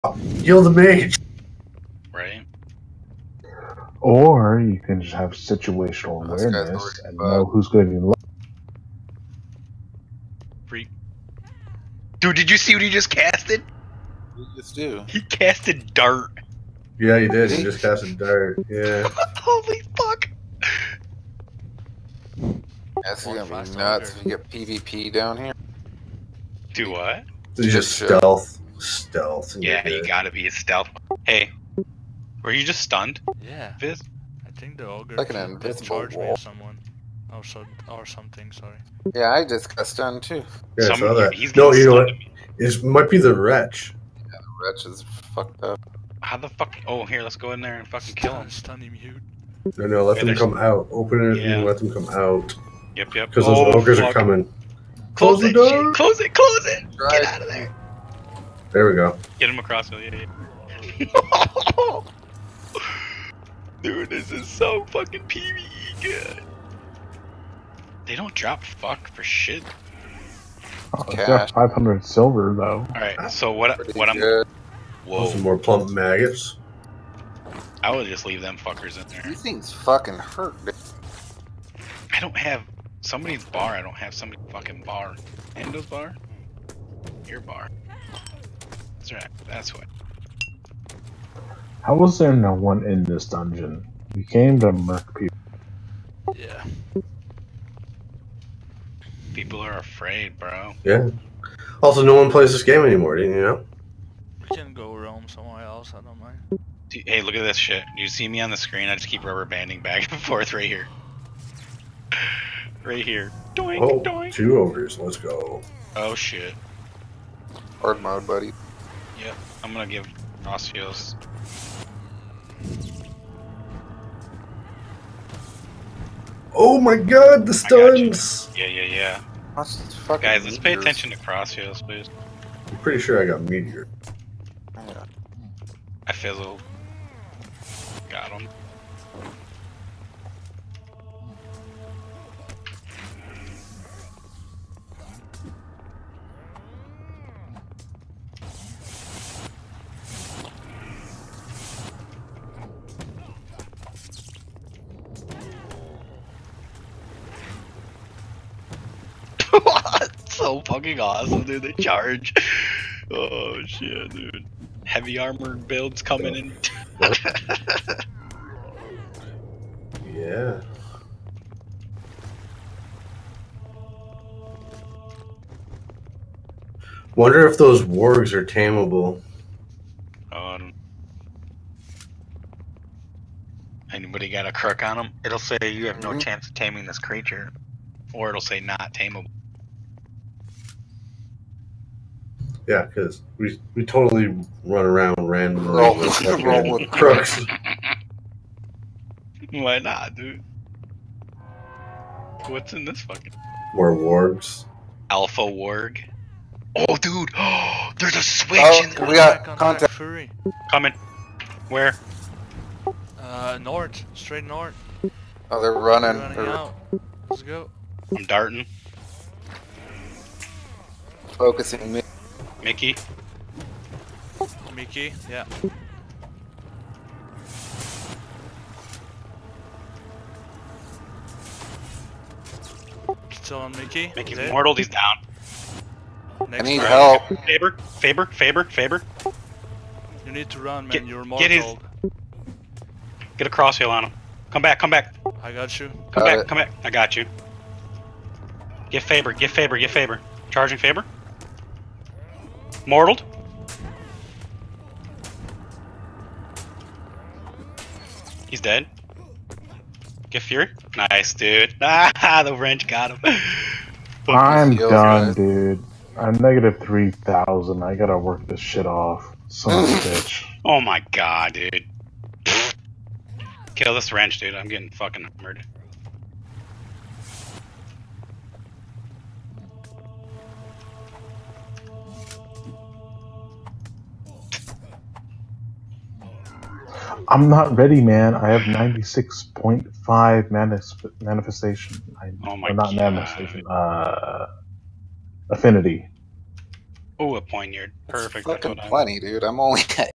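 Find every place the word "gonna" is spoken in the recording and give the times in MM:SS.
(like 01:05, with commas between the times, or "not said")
00:23, 01:59.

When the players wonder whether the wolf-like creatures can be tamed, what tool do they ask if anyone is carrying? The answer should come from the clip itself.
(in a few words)
crook.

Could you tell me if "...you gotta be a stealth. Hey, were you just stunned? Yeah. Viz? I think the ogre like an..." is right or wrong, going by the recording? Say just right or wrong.
right.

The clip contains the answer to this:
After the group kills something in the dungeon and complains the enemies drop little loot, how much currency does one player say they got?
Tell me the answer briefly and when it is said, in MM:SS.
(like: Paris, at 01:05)
500 silver, at 01:11.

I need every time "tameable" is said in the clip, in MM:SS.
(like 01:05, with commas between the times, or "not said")
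02:58, 03:08.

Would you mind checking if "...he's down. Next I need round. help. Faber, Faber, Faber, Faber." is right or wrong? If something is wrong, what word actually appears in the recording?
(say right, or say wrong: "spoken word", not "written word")
right.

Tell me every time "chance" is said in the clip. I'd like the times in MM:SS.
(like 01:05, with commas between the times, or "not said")
03:06.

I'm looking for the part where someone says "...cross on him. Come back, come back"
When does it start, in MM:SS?
04:03.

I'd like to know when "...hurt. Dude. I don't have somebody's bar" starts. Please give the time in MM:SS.
01:20.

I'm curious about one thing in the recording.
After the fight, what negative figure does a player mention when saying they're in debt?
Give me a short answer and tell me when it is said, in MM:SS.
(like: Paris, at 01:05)
-3,000, at 04:26.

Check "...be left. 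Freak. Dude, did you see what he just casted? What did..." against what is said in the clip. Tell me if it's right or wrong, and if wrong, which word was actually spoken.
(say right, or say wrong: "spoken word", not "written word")
right.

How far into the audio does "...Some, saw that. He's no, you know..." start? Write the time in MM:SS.
00:40.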